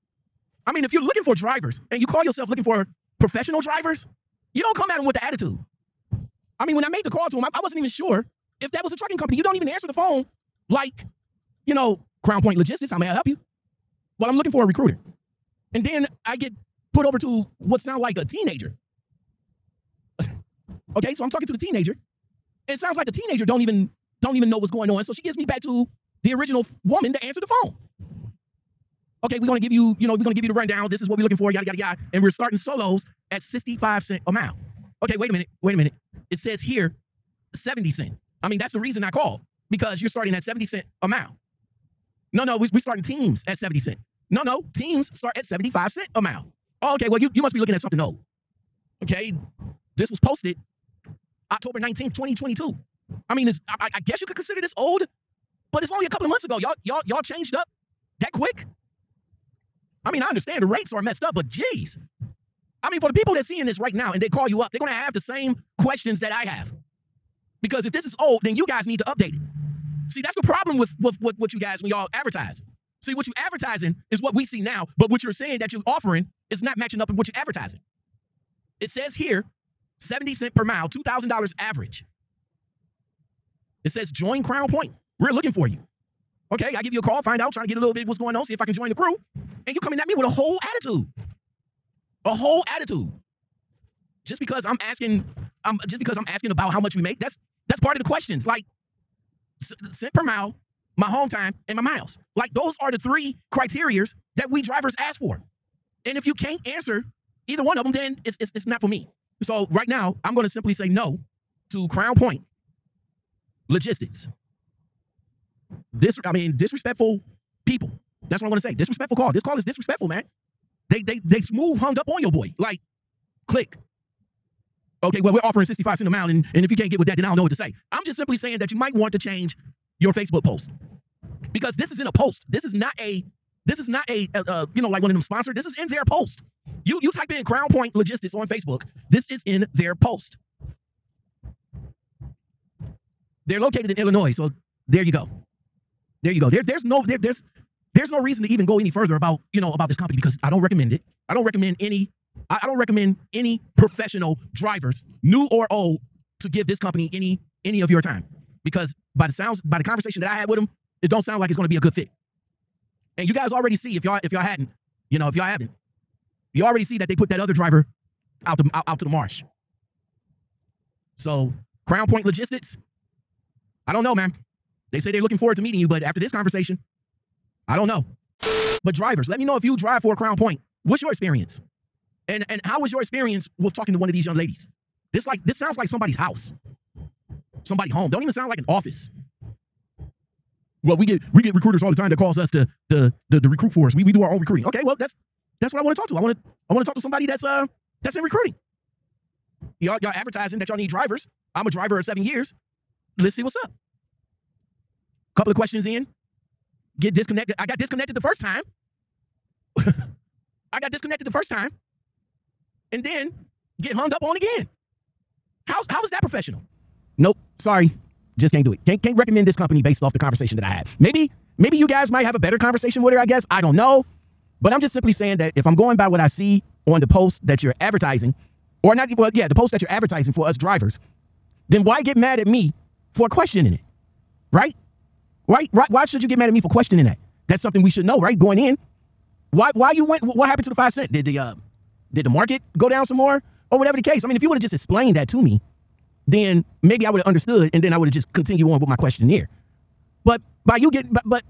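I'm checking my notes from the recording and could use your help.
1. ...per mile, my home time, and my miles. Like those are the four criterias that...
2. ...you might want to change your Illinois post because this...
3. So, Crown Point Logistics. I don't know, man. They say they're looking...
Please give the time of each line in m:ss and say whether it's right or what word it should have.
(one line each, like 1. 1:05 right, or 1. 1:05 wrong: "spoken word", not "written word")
1. 1:40 wrong: "three", not "four"
2. 2:08 wrong: "Facebook", not "Illinois"
3. 2:51 right.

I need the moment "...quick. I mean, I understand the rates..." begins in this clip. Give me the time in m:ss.
0:58.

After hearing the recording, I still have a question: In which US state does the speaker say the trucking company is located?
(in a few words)
Illinois.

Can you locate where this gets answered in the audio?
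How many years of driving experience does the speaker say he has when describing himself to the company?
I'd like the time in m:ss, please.
3:22.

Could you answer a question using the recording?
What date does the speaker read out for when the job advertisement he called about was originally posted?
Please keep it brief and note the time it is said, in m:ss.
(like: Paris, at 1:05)
October 19th, 2022, at 0:51.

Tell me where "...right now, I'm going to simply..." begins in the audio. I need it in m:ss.
1:49.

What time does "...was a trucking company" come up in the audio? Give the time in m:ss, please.
0:08.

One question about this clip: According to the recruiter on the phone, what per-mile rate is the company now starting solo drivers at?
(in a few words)
65 cents a mile.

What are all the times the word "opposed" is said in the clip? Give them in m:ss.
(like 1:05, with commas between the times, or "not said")
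not said.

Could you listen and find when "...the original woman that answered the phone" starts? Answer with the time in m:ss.
0:26.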